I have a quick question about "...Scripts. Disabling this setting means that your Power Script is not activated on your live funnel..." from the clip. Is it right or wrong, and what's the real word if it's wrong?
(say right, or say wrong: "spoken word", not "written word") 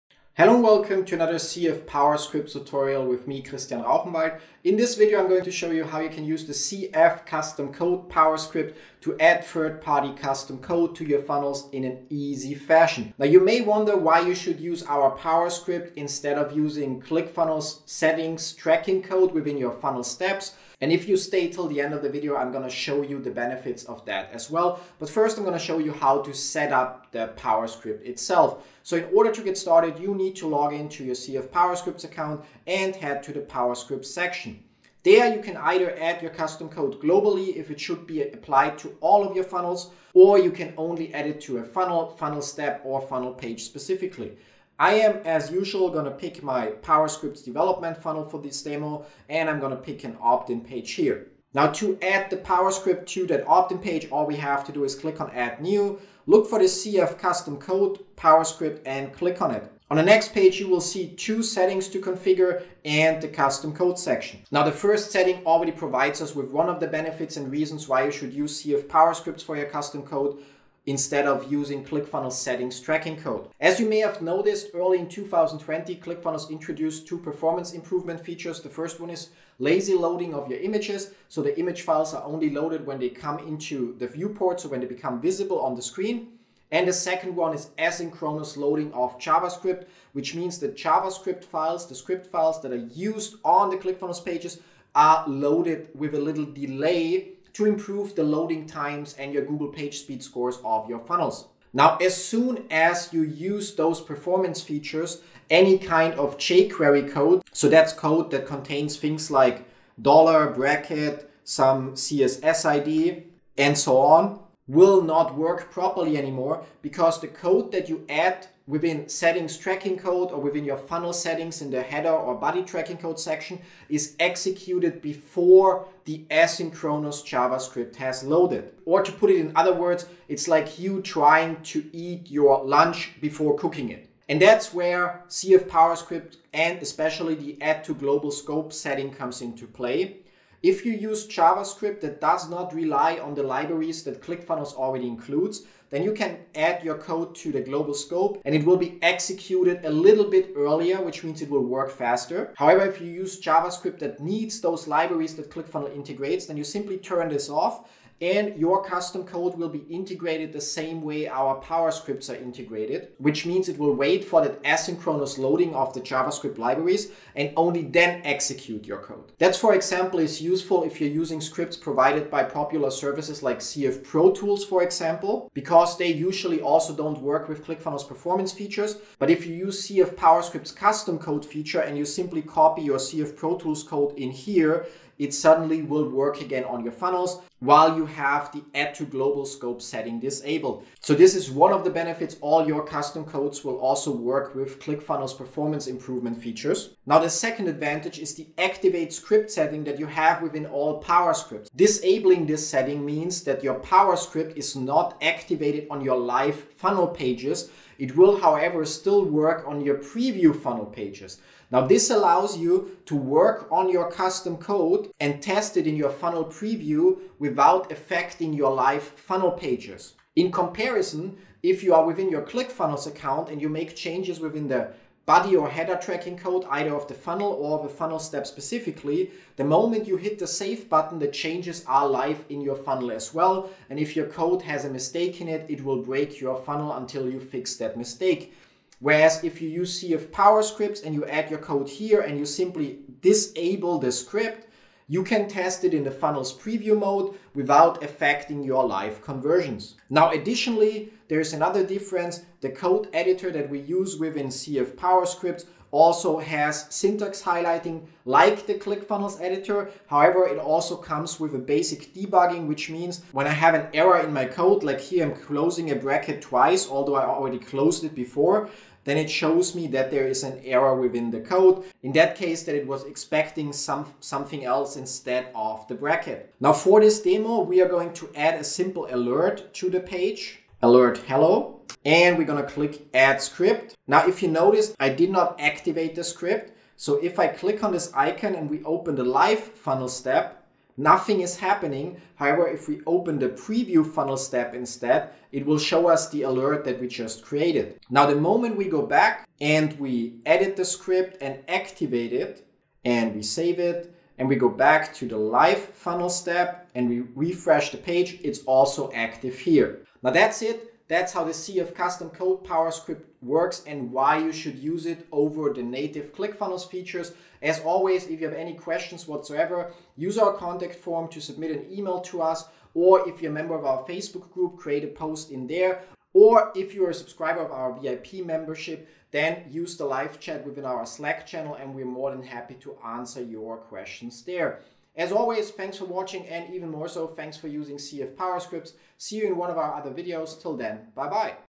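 right.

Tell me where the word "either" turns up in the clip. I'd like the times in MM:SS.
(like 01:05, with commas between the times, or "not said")
00:35, 03:46.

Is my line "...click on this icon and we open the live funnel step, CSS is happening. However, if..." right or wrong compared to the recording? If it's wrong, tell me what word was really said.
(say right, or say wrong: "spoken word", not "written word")
wrong: "Nothing", not "CSS".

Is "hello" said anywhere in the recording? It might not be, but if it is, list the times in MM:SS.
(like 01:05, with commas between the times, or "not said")
00:00, 04:41.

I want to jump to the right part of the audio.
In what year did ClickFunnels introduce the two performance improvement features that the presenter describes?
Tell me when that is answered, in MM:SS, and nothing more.
01:15.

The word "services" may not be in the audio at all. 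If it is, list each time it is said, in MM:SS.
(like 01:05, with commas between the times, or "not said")
02:52.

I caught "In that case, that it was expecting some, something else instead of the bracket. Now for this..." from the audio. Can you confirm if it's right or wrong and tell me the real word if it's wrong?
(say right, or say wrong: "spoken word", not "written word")
right.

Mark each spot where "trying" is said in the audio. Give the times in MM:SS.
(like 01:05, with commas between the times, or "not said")
02:11.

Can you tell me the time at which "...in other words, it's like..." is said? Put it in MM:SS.
02:09.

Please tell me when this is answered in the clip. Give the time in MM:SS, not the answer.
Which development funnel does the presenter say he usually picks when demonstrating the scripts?
00:46.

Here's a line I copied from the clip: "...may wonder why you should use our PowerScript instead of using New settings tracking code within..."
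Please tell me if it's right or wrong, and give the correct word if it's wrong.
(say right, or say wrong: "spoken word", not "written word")
wrong: "ClickFunnels", not "New".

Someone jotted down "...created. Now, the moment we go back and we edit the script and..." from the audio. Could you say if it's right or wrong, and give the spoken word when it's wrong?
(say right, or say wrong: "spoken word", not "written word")
right.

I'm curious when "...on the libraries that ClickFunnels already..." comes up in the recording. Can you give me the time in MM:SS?
02:23.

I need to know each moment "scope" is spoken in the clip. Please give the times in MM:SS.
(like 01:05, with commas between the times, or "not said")
02:18, 02:27, 03:09.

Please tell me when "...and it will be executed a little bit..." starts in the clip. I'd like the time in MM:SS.
02:28.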